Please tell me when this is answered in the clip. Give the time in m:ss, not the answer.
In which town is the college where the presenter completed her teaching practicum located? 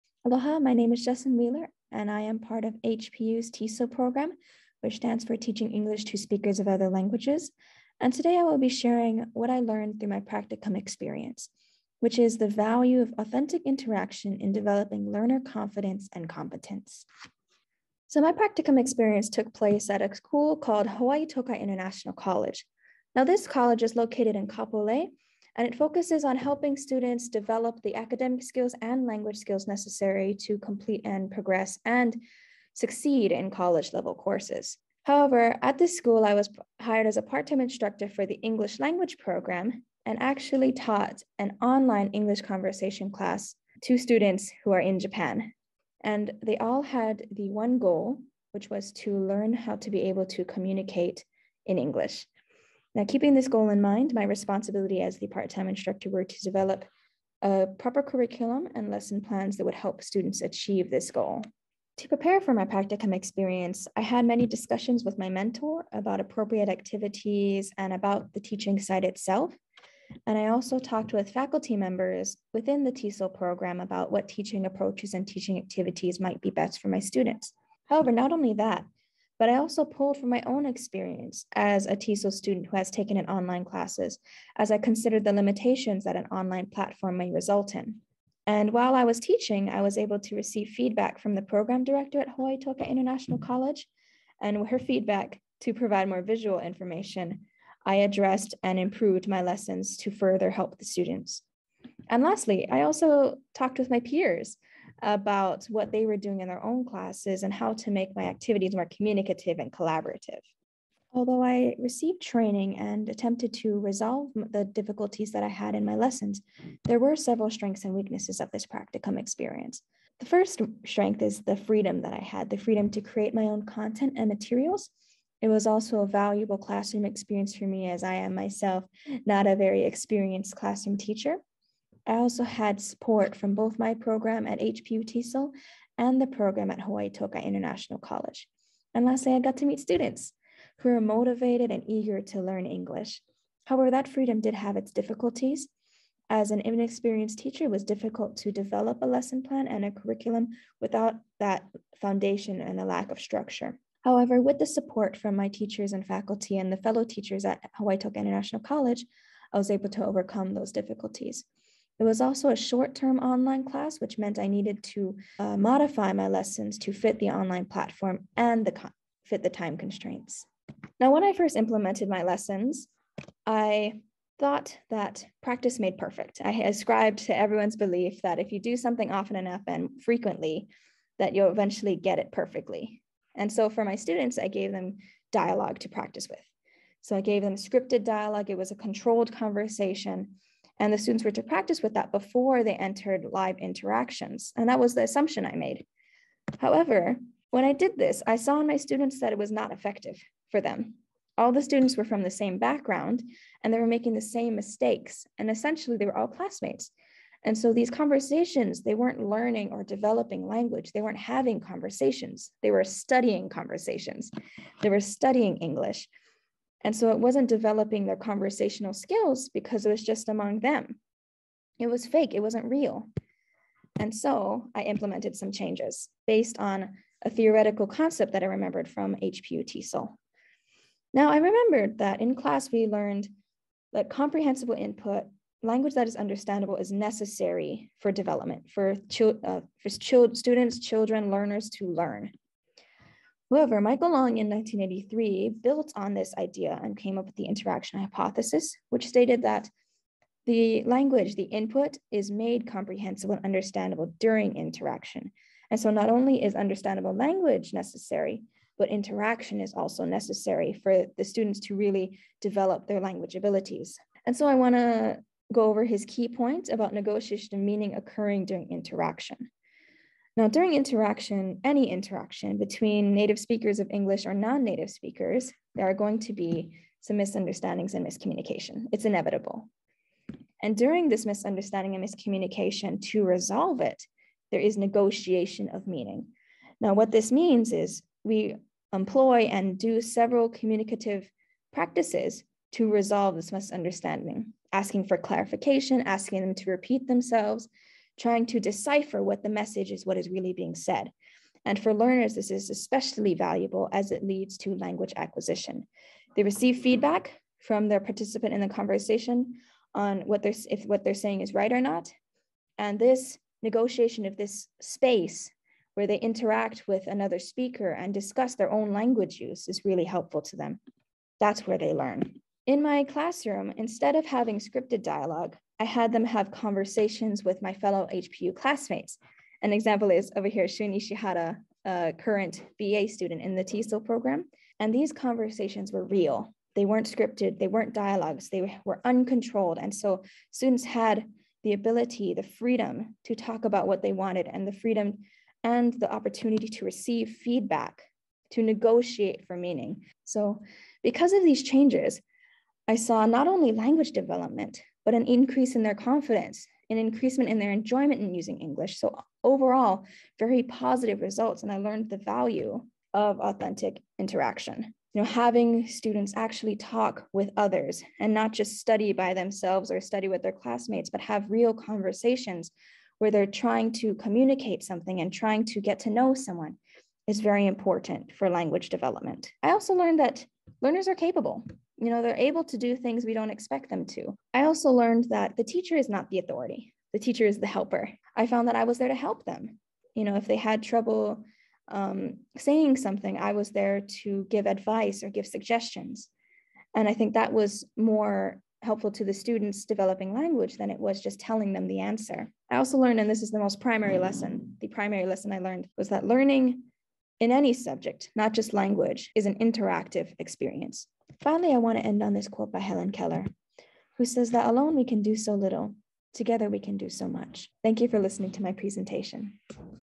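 0:24.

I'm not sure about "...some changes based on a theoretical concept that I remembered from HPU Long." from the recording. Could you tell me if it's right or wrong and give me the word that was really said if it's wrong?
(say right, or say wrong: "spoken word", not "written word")
wrong: "TESOL", not "Long".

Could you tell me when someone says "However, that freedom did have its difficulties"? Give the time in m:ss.
2:23.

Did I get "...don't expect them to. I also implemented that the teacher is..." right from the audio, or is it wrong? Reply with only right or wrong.
wrong.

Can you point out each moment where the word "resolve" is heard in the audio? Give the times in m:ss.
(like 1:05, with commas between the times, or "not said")
1:53, 4:43, 4:52.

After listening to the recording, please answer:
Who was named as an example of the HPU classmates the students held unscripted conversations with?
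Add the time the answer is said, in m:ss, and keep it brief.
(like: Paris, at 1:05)
Shun Ishihara, at 5:30.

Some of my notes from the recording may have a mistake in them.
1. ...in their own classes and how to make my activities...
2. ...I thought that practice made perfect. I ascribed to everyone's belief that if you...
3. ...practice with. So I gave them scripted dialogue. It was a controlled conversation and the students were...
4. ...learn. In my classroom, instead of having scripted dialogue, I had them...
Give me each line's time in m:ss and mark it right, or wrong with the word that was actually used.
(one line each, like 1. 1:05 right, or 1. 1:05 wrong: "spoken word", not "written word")
1. 1:46 right
2. 2:53 right
3. 3:05 right
4. 5:21 right.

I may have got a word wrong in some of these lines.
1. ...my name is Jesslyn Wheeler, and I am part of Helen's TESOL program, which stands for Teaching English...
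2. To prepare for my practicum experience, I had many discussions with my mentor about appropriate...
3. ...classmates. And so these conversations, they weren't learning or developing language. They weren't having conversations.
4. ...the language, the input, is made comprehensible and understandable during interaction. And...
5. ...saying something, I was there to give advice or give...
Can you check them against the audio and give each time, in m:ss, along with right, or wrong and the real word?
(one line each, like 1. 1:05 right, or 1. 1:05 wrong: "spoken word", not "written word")
1. 0:00 wrong: "HPU", not "Helen"
2. 1:01 right
3. 3:26 right
4. 4:10 right
5. 6:32 right.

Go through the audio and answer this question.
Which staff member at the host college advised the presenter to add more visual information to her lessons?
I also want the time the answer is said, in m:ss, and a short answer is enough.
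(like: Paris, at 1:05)
the program director, at 1:31.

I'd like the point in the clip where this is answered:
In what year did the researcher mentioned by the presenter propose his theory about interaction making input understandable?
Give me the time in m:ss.
4:04.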